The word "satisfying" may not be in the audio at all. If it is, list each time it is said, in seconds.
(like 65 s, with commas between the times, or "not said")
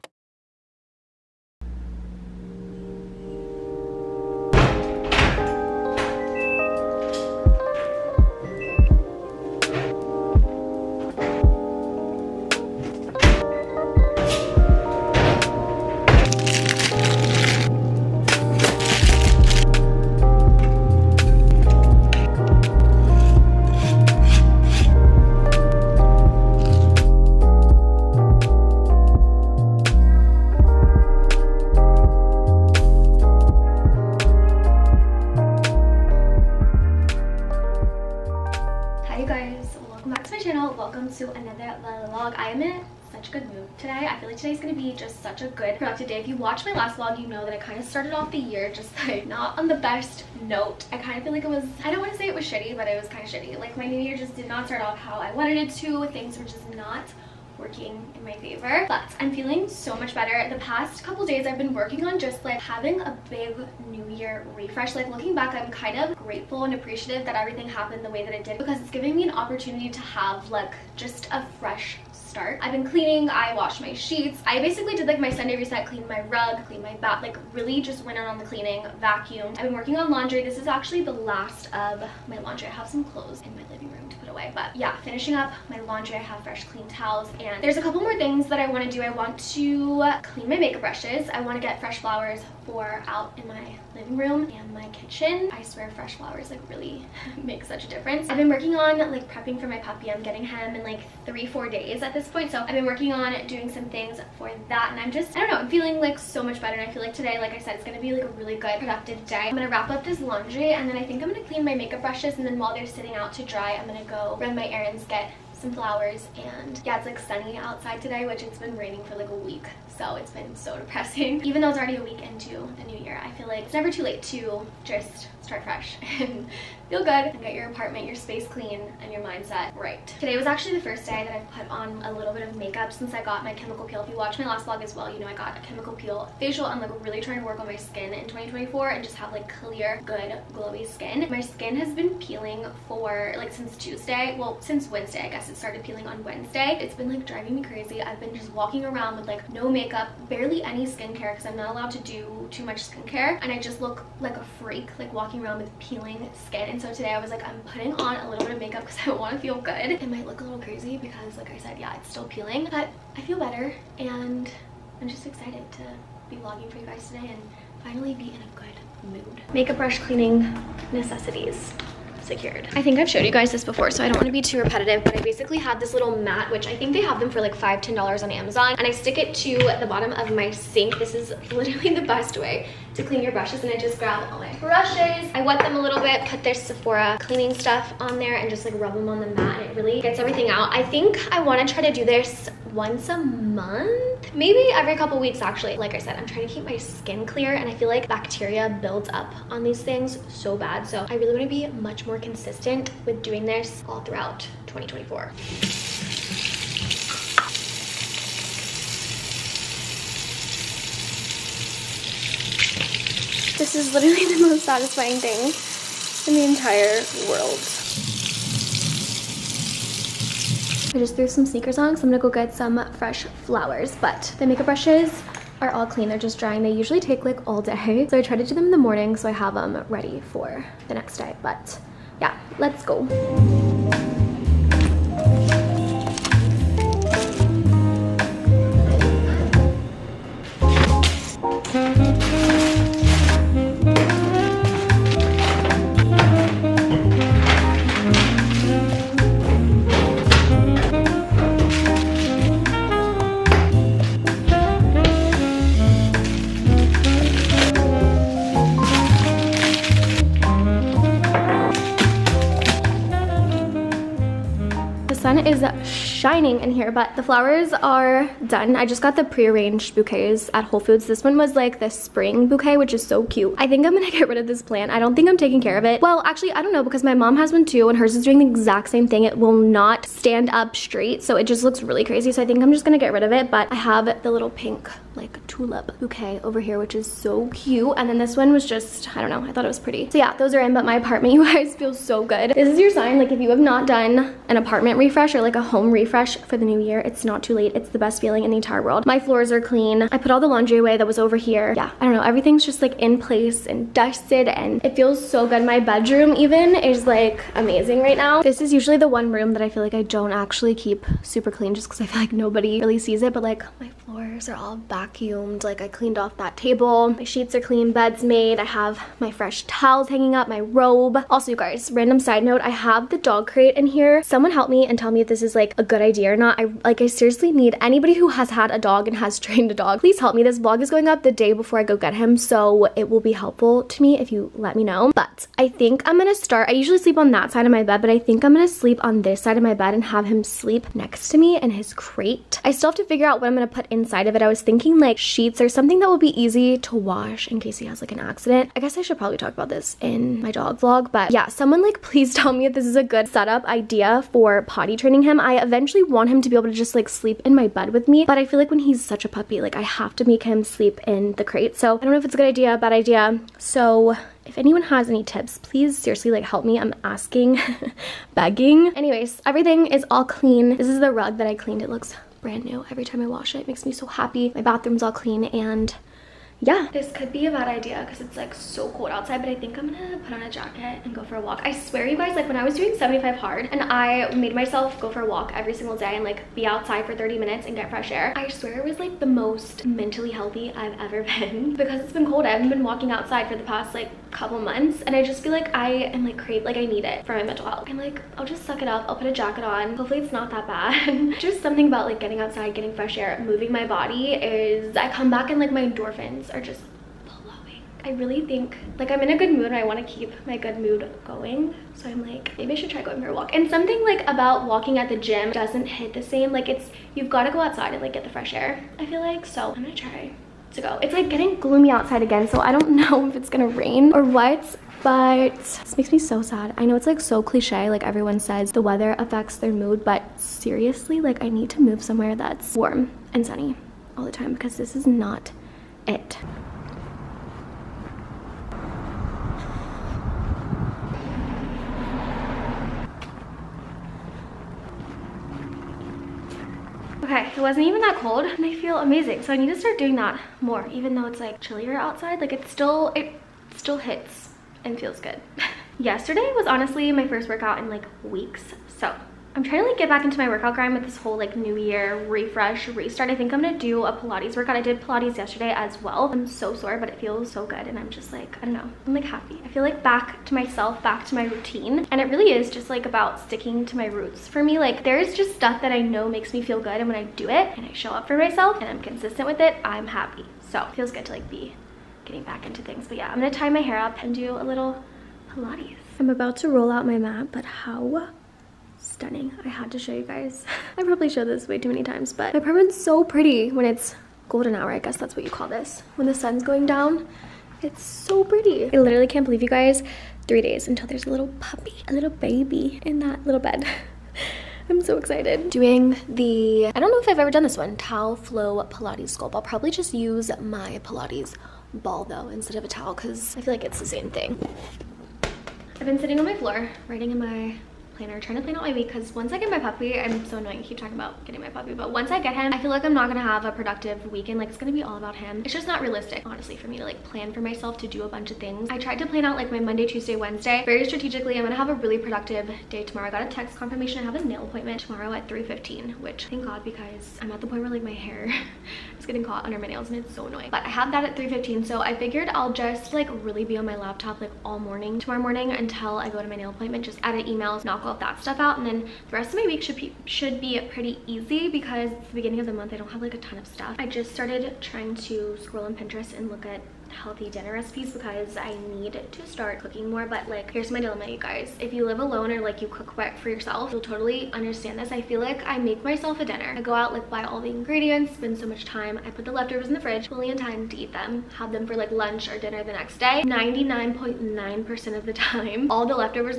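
214 s.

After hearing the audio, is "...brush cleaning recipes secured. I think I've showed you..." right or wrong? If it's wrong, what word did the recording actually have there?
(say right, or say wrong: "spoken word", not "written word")
wrong: "necessities", not "recipes".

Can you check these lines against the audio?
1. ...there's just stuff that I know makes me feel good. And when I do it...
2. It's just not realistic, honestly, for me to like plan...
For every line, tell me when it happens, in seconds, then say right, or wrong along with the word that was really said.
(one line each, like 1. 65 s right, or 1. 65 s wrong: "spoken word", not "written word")
1. 475 s right
2. 525 s right.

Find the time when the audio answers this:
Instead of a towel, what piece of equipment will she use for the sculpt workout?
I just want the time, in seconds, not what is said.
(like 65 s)
511 s.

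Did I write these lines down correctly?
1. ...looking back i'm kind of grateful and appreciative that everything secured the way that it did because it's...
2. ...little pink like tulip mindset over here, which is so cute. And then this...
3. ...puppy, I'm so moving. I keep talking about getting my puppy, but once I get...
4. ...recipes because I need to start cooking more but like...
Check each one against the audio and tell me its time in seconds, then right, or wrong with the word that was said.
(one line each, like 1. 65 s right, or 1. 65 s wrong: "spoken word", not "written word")
1. 65 s wrong: "happened", not "secured"
2. 284 s wrong: "bouquet", not "mindset"
3. 519 s wrong: "annoying", not "moving"
4. 557 s right.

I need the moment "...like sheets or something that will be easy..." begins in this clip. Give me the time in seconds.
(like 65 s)
344 s.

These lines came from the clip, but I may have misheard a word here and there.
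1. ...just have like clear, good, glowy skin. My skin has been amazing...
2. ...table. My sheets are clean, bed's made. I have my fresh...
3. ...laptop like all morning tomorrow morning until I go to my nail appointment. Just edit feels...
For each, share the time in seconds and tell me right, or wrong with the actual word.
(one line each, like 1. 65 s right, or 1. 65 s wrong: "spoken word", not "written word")
1. 139 s wrong: "peeling", not "amazing"
2. 316 s right
3. 543 s wrong: "emails", not "feels".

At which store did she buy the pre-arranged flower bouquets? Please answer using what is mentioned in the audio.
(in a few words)
Whole Foods.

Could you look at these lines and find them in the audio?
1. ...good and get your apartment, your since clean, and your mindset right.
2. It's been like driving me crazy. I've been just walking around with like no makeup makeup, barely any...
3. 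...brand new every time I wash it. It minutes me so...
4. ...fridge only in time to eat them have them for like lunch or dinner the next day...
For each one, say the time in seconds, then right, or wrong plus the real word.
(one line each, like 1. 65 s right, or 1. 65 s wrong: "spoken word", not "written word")
1. 126 s wrong: "space", not "since"
2. 146 s right
3. 372 s wrong: "makes", not "minutes"
4. 569 s right.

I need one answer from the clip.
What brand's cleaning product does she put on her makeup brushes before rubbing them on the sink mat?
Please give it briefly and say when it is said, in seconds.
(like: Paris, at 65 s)
Sephora, at 186 s.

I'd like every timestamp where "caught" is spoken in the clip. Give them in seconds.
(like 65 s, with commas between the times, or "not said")
539 s.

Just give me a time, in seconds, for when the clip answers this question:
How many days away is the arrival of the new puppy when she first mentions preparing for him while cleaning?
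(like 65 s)
101 s.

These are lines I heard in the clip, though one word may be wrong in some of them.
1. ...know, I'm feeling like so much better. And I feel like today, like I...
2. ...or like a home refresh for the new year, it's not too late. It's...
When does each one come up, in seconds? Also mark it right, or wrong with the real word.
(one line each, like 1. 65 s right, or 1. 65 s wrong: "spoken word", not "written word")
1. 105 s right
2. 295 s right.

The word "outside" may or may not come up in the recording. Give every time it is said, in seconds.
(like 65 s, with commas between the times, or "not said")
117 s, 379 s, 386 s, 393 s, 402 s, 417 s, 421 s, 451 s.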